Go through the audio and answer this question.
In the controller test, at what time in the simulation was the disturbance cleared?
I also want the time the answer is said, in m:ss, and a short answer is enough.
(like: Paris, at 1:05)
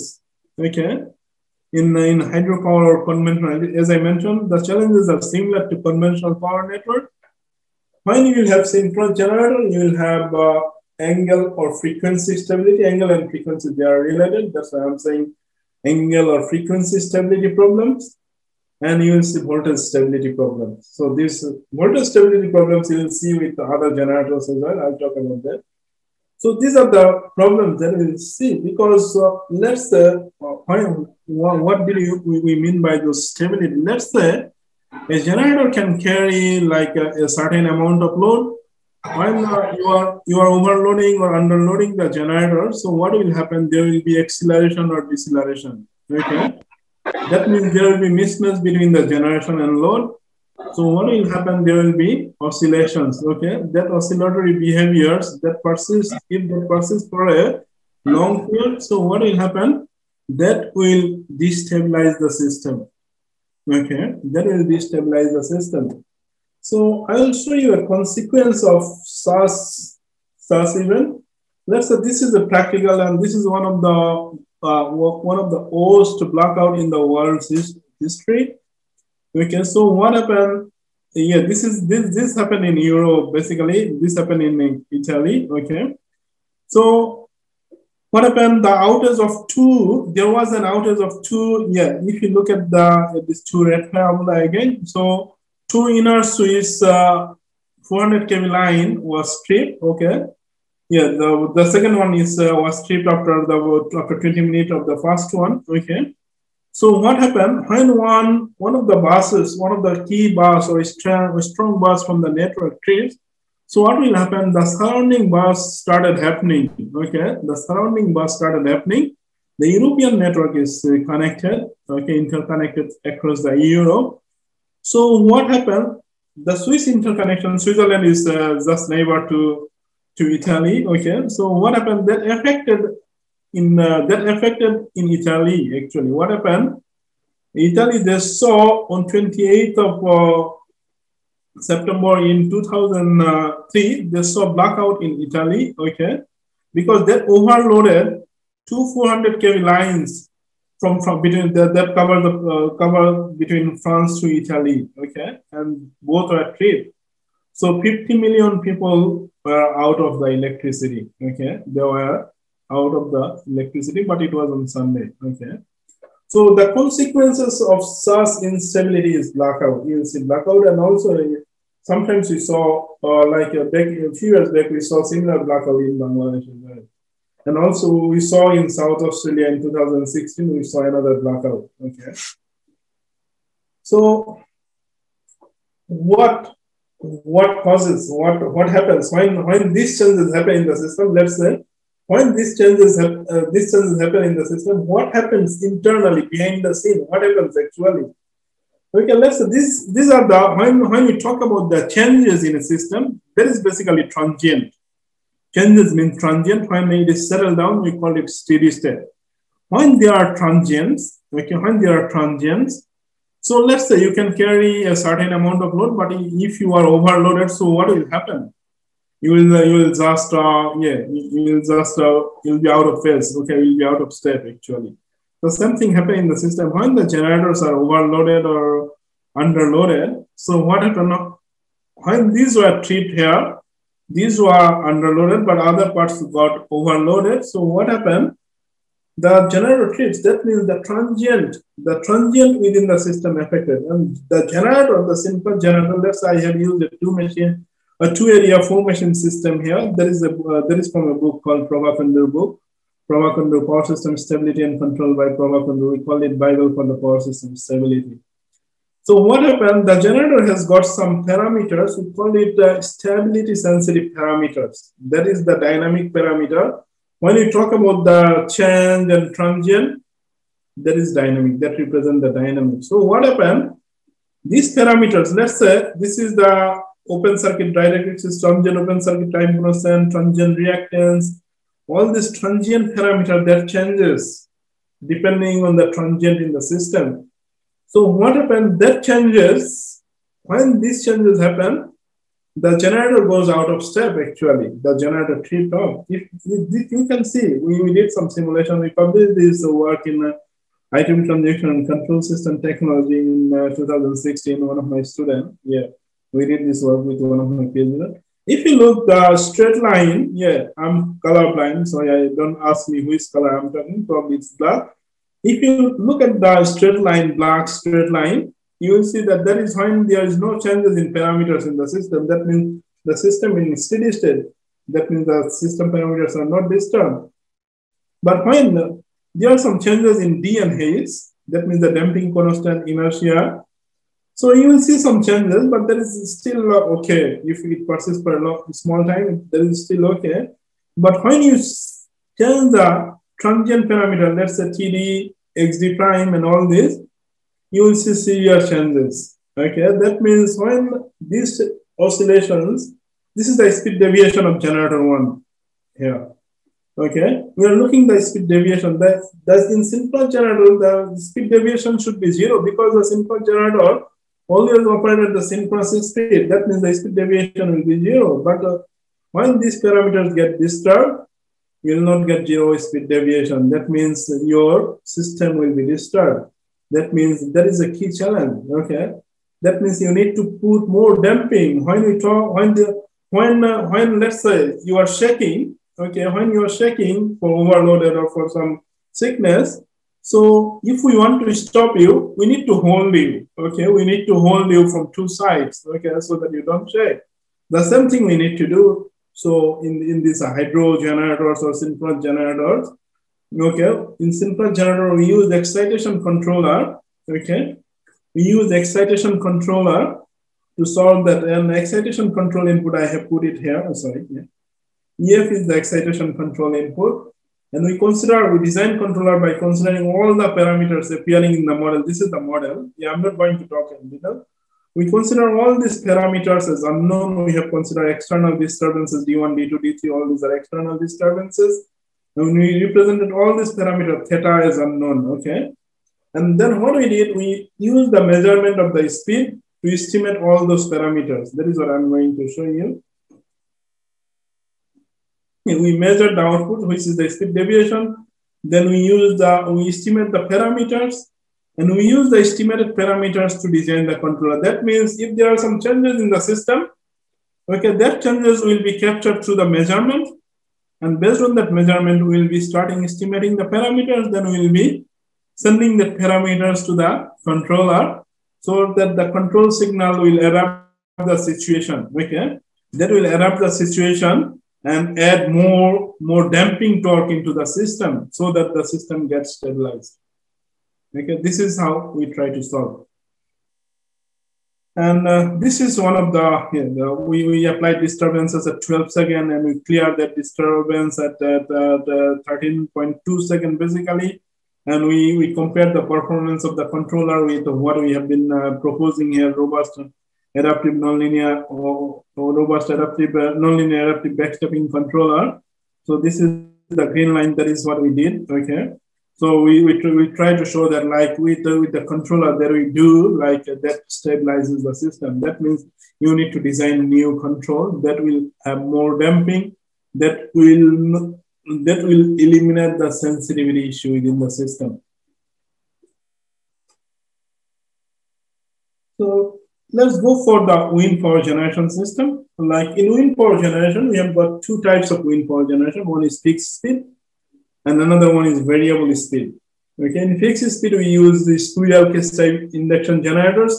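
13.2 seconds, at 8:12.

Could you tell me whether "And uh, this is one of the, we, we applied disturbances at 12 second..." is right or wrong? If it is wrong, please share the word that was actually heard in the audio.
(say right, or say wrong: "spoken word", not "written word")
right.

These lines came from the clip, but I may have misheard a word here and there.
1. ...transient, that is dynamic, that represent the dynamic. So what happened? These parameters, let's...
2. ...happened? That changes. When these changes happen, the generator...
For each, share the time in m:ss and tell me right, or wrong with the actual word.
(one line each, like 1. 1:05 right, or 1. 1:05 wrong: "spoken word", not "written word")
1. 4:29 right
2. 4:48 right.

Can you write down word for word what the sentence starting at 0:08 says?
When you will have synchronous generator, you will have uh, angle or frequency stability.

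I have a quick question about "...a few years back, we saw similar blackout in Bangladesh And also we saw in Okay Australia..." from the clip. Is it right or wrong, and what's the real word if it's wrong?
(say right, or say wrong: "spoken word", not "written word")
wrong: "South", not "Okay".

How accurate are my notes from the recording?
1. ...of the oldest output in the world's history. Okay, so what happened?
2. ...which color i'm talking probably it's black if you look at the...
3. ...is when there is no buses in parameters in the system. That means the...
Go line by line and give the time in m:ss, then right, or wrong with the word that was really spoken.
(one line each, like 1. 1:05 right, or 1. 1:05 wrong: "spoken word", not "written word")
1. 1:15 wrong: "blackout", not "output"
2. 5:13 right
3. 5:19 wrong: "changes", not "buses".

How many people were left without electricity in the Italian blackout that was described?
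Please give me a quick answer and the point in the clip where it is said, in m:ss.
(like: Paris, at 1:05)
50 million, at 2:37.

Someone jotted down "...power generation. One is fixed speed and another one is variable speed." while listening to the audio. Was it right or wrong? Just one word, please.
right.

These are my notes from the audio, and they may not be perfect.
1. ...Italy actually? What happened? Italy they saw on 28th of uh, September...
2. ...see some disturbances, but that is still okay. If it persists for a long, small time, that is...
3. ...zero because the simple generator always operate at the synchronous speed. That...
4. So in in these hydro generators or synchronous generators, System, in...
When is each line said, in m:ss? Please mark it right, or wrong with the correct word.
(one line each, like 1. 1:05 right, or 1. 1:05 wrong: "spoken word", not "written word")
1. 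2:15 right
2. 5:34 wrong: "changes", not "disturbances"
3. 6:02 right
4. 6:39 wrong: "Okay", not "System".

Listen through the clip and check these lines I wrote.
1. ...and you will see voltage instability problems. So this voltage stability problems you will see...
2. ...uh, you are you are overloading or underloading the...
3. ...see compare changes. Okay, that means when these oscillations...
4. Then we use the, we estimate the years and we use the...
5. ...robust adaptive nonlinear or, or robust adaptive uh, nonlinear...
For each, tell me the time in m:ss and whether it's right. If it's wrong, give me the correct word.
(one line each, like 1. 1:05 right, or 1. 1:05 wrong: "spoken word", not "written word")
1. 0:18 wrong: "stability", not "instability"
2. 0:39 right
3. 5:48 wrong: "severe", not "compare"
4. 7:28 wrong: "parameters", not "years"
5. 8:19 right.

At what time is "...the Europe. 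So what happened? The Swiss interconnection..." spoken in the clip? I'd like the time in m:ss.
2:03.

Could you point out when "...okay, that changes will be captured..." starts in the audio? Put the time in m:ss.
7:37.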